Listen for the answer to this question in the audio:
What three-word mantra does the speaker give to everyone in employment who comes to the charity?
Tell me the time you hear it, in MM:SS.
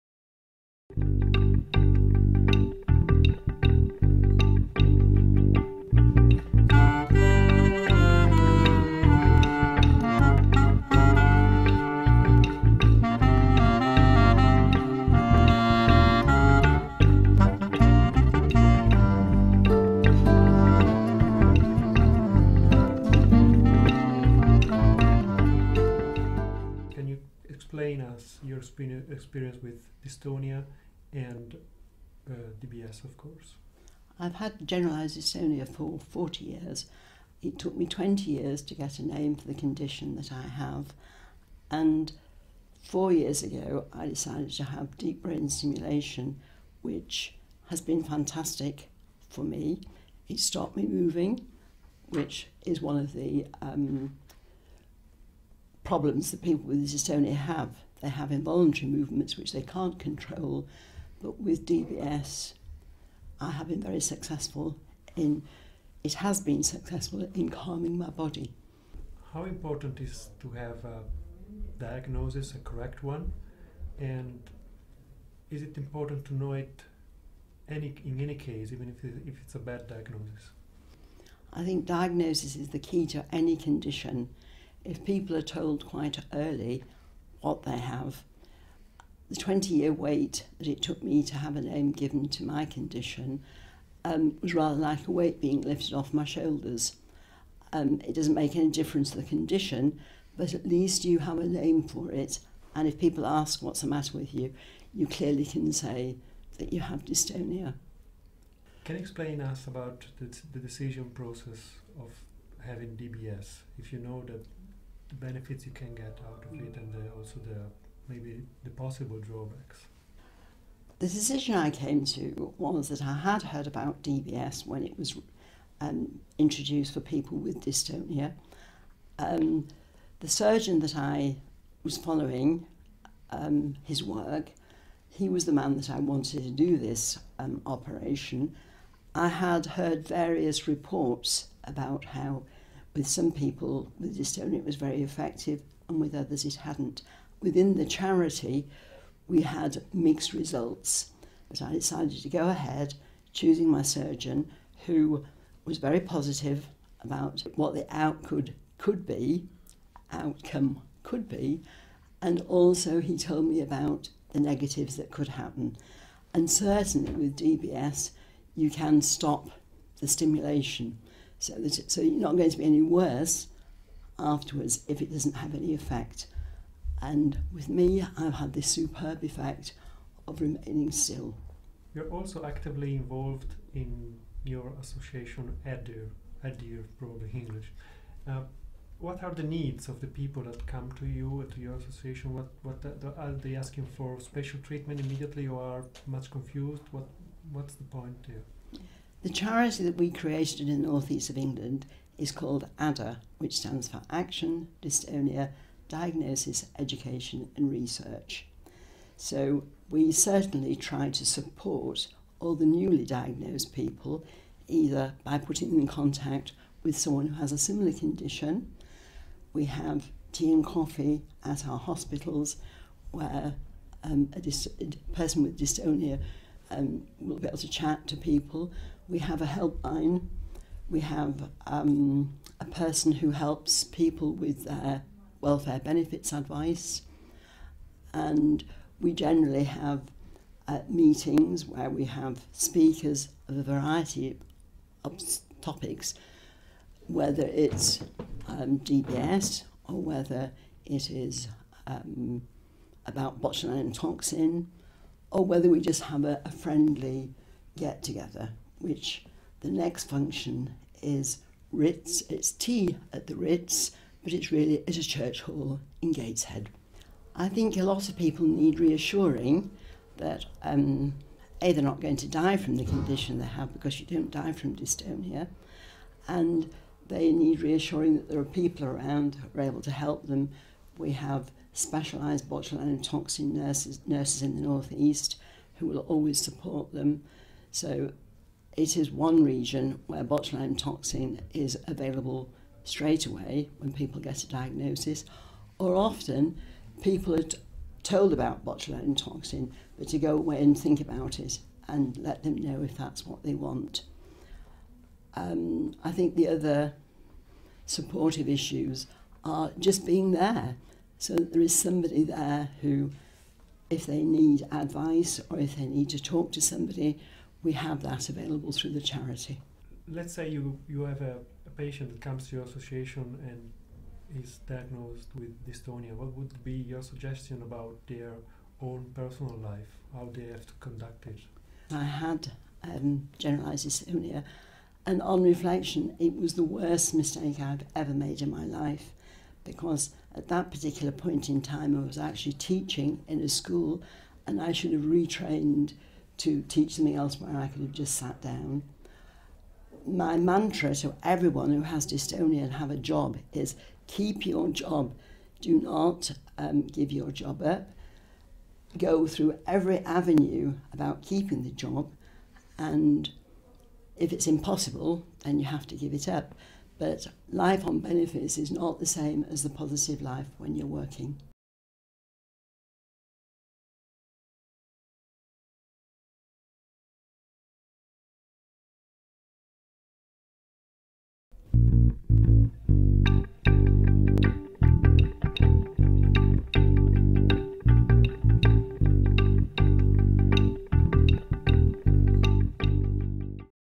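05:54.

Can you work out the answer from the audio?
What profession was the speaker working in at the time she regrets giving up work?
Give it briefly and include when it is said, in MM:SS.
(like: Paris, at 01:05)
Teaching, at 05:42.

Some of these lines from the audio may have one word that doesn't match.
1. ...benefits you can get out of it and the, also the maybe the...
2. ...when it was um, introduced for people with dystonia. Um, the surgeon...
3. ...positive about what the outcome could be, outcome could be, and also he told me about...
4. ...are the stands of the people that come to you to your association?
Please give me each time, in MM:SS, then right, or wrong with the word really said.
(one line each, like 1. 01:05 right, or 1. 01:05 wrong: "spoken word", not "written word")
1. 01:55 right
2. 02:04 right
3. 02:36 right
4. 03:09 wrong: "needs", not "stands".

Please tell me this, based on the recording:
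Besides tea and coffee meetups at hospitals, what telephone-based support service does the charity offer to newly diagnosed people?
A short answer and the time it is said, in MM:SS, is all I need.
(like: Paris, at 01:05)
A helpline, at 03:49.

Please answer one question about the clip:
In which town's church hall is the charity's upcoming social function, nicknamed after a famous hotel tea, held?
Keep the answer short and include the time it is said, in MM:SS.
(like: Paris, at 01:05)
Gateshead, at 04:26.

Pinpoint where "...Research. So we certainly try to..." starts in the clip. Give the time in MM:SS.
03:27.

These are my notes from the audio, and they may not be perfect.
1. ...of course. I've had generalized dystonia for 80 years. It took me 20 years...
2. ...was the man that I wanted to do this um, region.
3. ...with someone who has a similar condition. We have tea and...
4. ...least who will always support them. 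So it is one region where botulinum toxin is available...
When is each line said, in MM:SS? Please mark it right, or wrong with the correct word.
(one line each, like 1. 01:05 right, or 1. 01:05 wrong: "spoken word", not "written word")
1. 00:33 wrong: "40", not "80"
2. 02:15 wrong: "operation", not "region"
3. 03:36 right
4. 04:44 wrong: "northeast", not "least".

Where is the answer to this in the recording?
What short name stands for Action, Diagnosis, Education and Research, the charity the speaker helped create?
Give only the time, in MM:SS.
03:22.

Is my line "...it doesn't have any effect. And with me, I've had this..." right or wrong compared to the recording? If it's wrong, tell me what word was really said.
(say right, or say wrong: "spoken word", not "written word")
right.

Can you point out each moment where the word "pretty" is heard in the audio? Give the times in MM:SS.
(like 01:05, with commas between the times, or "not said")
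not said.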